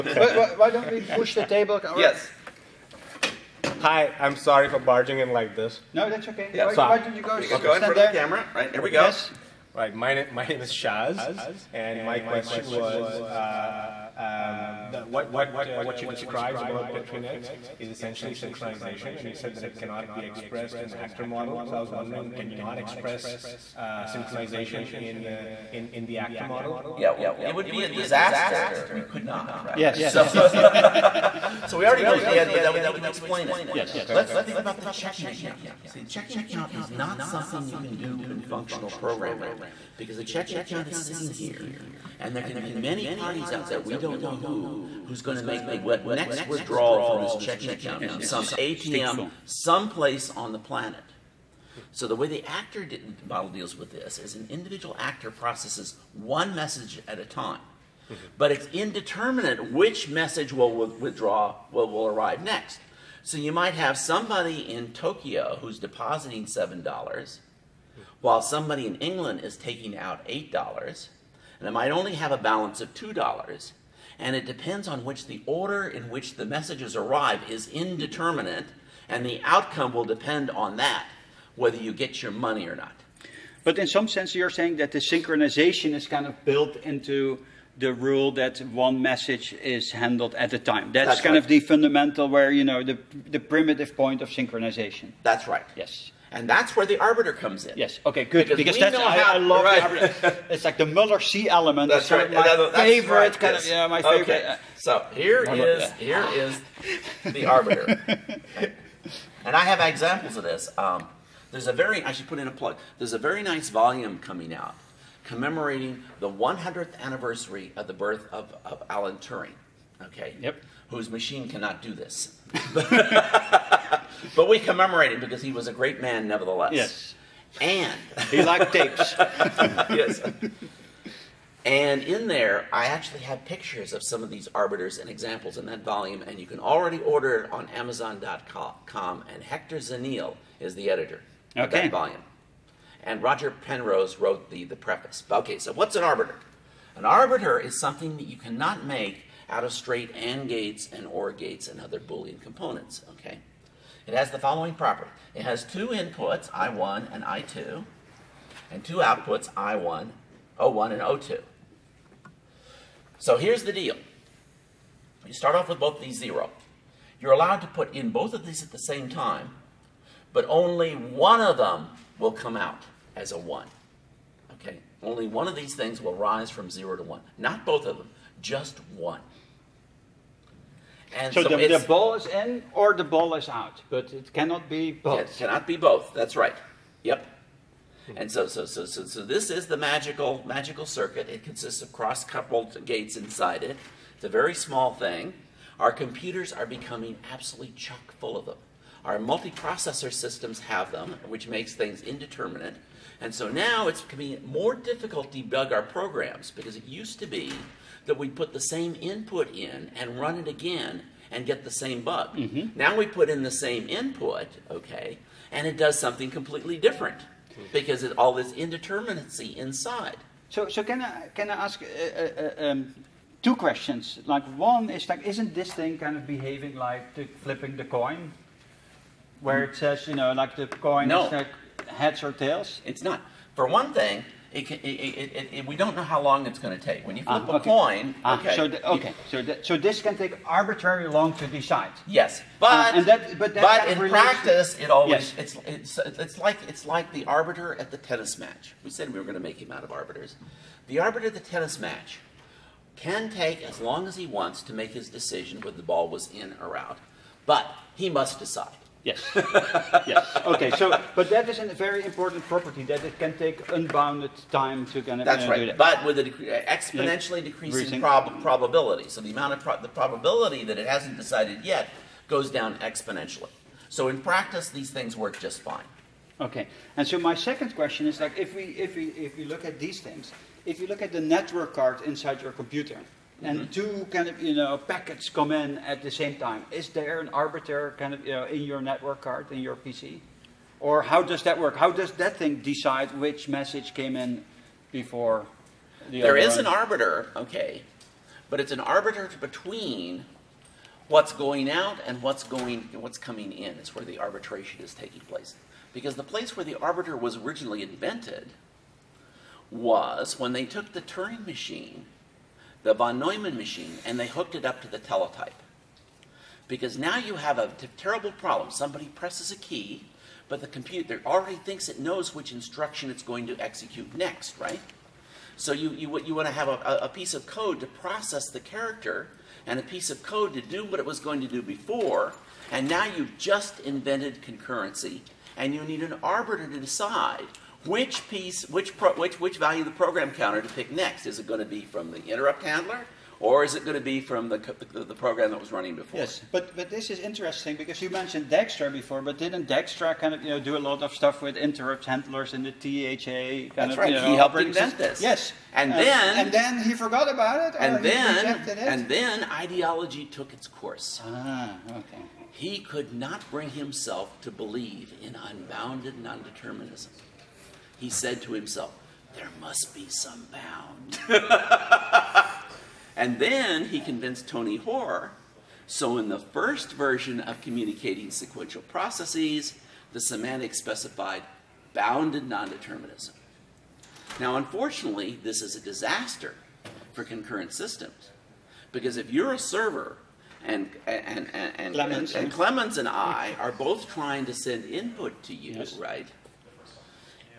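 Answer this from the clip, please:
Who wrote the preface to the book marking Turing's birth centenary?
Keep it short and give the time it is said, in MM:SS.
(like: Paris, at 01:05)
Roger Penrose, at 02:23.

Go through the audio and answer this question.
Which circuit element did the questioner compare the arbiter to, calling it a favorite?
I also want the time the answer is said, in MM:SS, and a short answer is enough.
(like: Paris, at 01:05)
Muller C element, at 01:40.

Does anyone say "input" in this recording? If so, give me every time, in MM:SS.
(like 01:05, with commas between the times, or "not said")
02:35, 03:28, 03:33, 06:34.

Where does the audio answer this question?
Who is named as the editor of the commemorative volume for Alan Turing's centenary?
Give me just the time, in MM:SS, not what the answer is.
02:19.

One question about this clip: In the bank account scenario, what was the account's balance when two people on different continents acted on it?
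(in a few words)
$2.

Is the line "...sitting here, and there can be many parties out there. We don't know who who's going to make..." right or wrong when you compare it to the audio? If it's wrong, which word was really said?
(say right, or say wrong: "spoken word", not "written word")
right.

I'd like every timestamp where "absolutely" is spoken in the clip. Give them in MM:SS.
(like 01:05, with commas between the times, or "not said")
03:17.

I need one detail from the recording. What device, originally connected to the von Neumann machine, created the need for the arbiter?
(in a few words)
teletype.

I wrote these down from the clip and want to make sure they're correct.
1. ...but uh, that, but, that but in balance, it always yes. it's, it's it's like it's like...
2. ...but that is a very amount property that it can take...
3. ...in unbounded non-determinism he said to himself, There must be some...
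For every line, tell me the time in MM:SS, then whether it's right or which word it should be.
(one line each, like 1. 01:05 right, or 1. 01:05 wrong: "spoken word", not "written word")
1. 04:02 wrong: "practice", not "balance"
2. 04:21 wrong: "important", not "amount"
3. 06:05 right.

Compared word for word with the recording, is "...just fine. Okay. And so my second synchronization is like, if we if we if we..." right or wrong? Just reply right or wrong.
wrong.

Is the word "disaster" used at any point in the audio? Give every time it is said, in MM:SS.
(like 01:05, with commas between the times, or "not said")
00:27, 06:25.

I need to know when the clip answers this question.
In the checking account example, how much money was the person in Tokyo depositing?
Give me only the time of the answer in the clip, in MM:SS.
01:06.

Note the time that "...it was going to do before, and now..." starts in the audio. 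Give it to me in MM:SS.
05:30.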